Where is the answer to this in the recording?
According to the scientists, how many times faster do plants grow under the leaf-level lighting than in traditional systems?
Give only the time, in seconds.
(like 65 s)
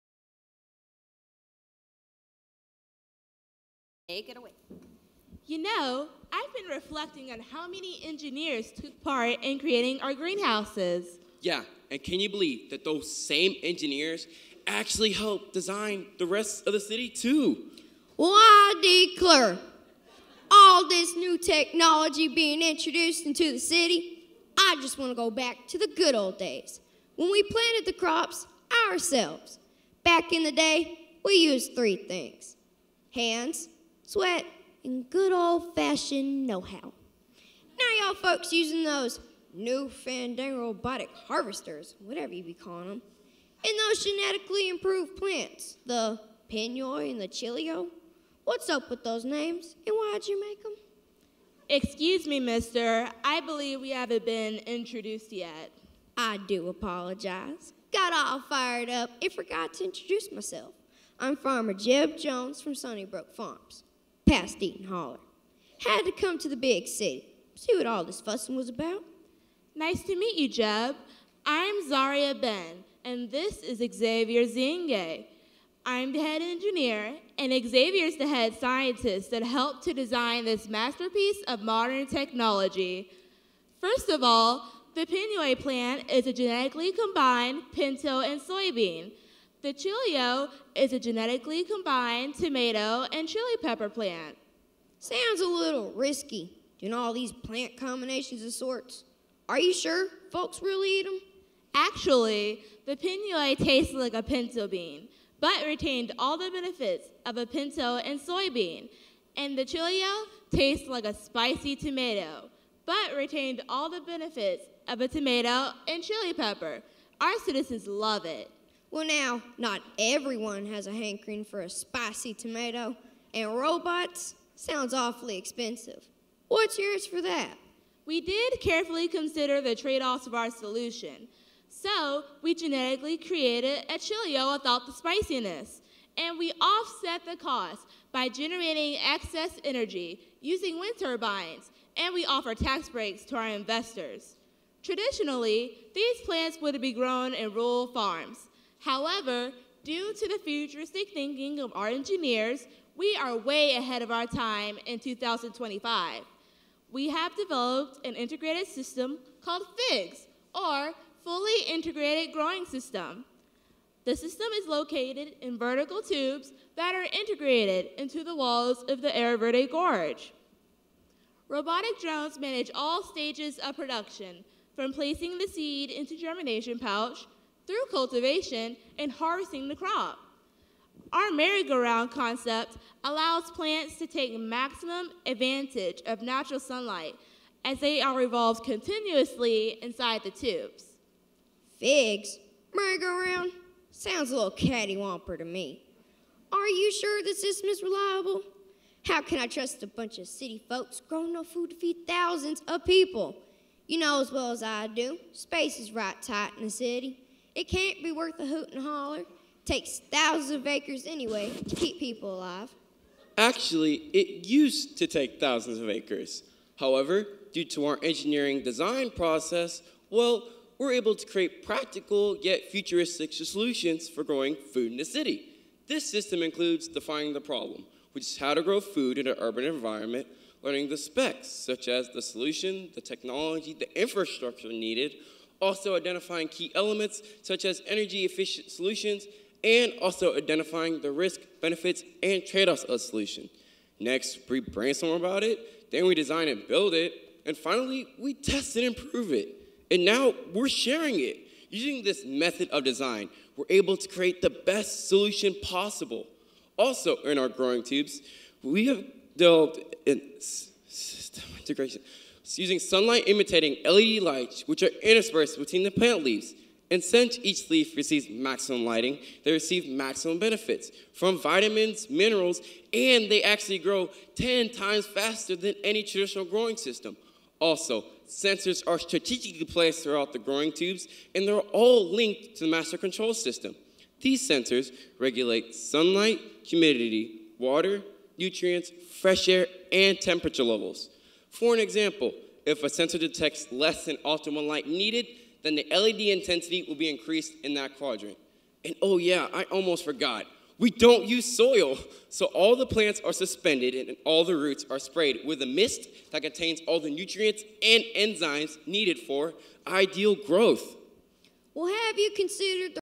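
274 s.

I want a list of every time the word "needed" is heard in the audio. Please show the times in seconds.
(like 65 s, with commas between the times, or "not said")
234 s, 294 s, 308 s.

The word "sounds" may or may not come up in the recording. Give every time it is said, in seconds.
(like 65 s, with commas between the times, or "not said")
94 s, 124 s, 193 s.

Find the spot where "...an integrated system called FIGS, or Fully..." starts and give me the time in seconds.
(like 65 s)
158 s.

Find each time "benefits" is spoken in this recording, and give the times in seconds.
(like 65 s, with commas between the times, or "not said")
106 s, 114 s, 241 s, 270 s.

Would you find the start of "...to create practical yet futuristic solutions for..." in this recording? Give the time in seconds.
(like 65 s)
221 s.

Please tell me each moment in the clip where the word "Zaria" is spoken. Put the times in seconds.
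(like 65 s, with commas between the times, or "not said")
71 s.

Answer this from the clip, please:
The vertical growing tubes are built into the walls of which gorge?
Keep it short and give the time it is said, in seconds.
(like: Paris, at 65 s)
Air Verde Gorge, at 169 s.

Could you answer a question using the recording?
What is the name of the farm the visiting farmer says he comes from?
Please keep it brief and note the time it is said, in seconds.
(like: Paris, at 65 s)
Sunnybrook Farms, at 62 s.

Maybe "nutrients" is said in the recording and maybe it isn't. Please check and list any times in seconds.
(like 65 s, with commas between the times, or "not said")
288 s, 307 s.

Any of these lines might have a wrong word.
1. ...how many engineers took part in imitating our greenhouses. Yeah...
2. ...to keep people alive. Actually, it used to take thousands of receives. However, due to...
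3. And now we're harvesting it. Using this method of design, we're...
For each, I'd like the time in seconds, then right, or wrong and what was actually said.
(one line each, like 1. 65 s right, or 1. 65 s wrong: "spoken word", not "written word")
1. 7 s wrong: "creating", not "imitating"
2. 211 s wrong: "acres", not "receives"
3. 249 s wrong: "sharing", not "harvesting".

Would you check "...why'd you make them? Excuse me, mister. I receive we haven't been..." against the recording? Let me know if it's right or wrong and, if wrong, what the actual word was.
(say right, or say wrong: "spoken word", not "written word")
wrong: "believe", not "receive".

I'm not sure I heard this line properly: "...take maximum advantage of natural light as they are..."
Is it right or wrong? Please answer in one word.
wrong.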